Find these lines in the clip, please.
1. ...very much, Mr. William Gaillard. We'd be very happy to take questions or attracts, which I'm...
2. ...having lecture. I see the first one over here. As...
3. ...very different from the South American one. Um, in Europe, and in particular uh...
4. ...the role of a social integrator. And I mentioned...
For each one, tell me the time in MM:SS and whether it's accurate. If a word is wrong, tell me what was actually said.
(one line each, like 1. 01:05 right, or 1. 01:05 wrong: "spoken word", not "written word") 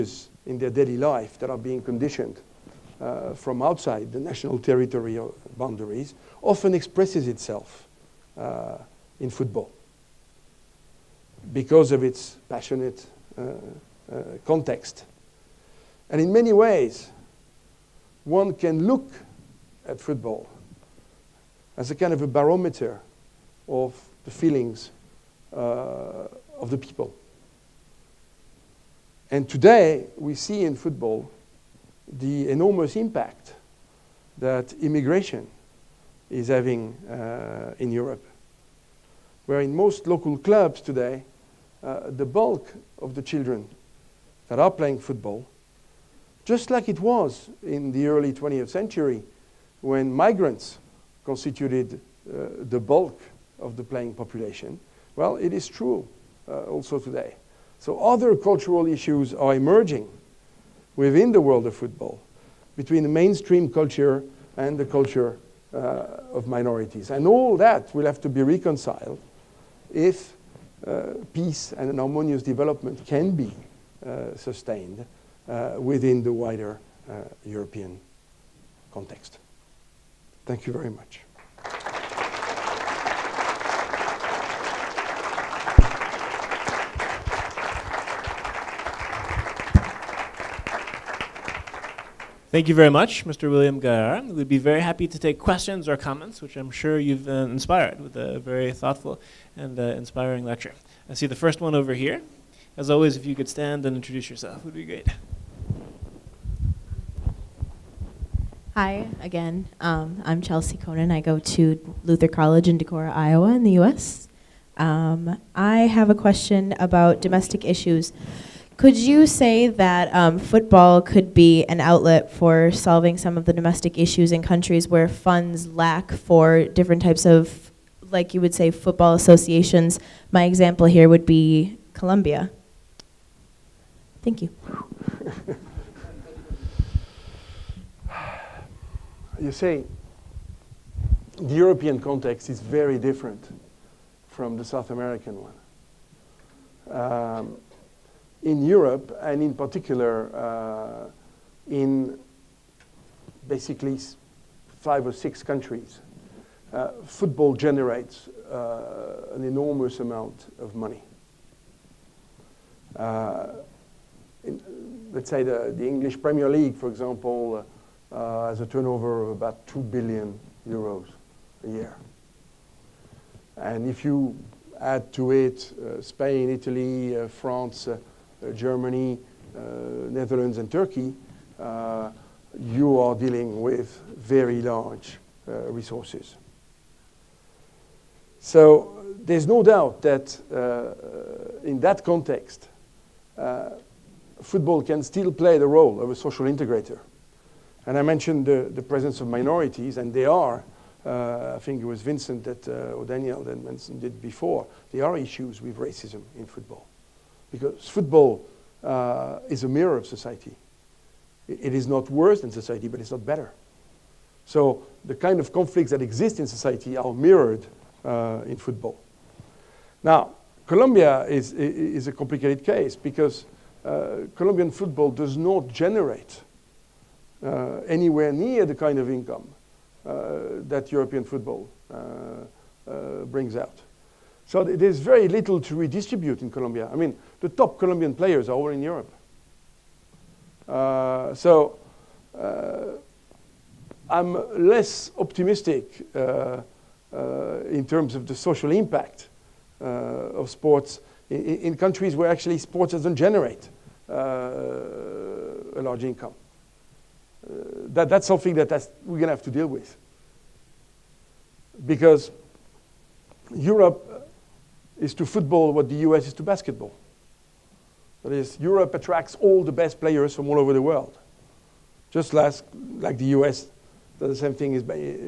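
1. 01:32 wrong: "comments", not "attracts"
2. 01:40 wrong: "inspiring", not "having"
3. 02:22 right
4. 03:15 right.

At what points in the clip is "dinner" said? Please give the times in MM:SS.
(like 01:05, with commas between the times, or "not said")
not said.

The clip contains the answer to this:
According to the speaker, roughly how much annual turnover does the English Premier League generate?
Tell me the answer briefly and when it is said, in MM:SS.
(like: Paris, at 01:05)
2 billion euros, at 02:49.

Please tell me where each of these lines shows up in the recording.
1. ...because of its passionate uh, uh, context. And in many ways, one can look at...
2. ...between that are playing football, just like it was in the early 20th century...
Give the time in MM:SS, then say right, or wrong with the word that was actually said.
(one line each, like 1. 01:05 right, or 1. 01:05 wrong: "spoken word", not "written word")
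1. 00:11 right
2. 00:43 wrong: "children", not "between".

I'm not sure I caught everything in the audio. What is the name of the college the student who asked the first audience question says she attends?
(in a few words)
Luther College.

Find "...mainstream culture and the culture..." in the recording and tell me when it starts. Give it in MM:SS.
01:03.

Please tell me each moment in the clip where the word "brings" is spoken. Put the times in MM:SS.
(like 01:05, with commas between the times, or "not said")
03:53.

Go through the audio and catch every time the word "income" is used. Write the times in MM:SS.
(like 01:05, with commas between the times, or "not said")
03:49, 04:16.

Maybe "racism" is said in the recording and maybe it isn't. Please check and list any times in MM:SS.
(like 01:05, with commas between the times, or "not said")
03:25.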